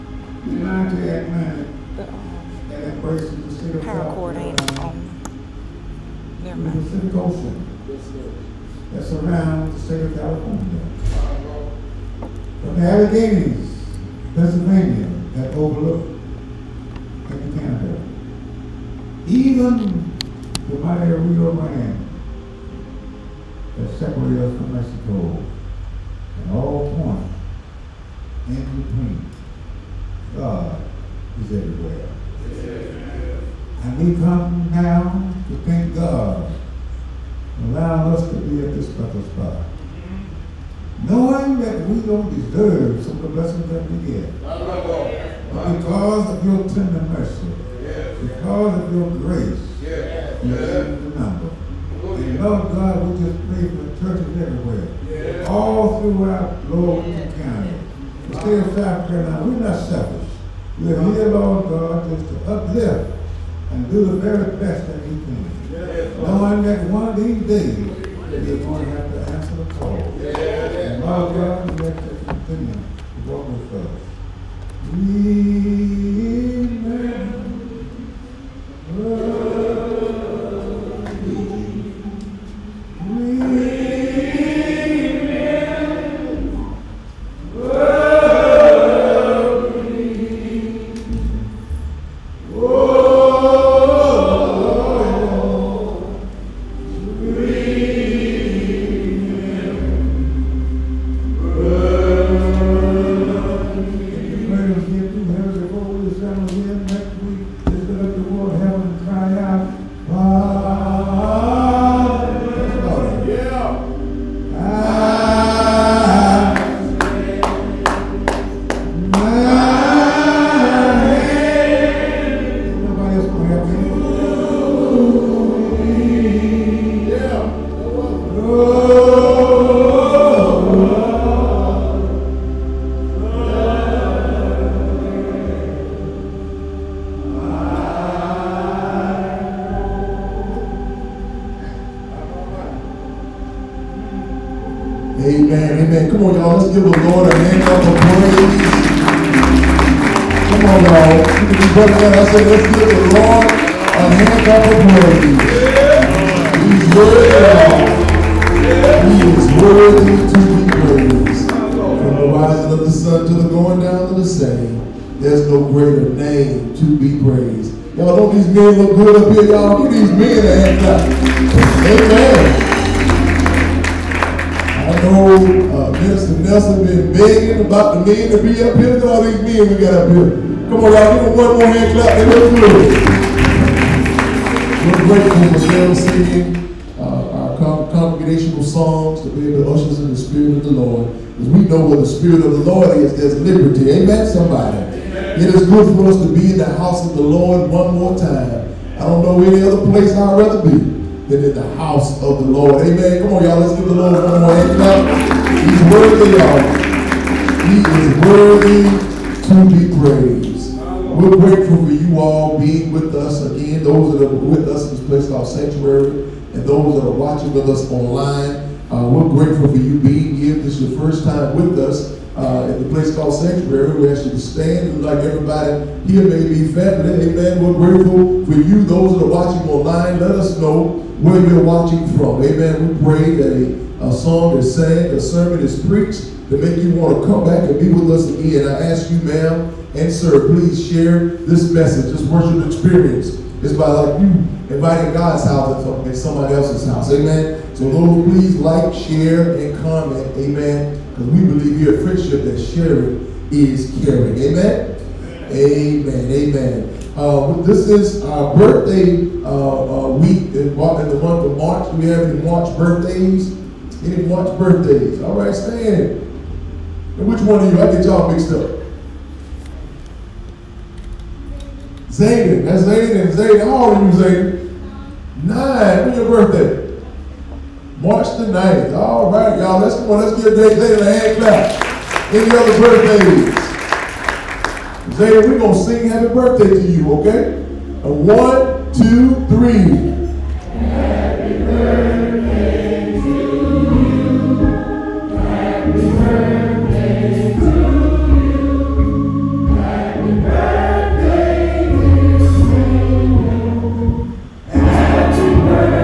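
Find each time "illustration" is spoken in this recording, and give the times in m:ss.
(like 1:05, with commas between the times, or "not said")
not said.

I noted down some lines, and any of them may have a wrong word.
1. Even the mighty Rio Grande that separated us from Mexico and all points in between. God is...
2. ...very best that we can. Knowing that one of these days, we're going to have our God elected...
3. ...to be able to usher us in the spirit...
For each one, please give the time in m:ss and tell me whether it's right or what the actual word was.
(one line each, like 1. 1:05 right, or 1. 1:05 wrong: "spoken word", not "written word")
1. 0:19 right
2. 1:04 right
3. 3:09 right.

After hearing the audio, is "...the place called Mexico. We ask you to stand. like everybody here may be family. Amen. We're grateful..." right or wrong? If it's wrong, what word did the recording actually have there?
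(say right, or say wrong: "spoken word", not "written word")
wrong: "Sanctuary", not "Mexico".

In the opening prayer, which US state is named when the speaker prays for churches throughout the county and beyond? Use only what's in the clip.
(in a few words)
South Carolina.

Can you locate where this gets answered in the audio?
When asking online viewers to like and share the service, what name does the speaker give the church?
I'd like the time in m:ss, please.
4:12.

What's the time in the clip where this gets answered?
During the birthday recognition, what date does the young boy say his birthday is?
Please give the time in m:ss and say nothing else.
4:37.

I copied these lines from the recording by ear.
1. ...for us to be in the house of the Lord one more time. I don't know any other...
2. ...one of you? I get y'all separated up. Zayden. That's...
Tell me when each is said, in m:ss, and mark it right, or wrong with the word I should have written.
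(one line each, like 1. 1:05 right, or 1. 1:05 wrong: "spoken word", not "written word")
1. 3:15 right
2. 4:27 wrong: "mixed", not "separated".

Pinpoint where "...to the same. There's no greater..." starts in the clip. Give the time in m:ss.
2:44.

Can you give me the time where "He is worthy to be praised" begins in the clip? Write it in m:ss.
3:27.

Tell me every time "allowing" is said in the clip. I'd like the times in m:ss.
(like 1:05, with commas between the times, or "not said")
0:37.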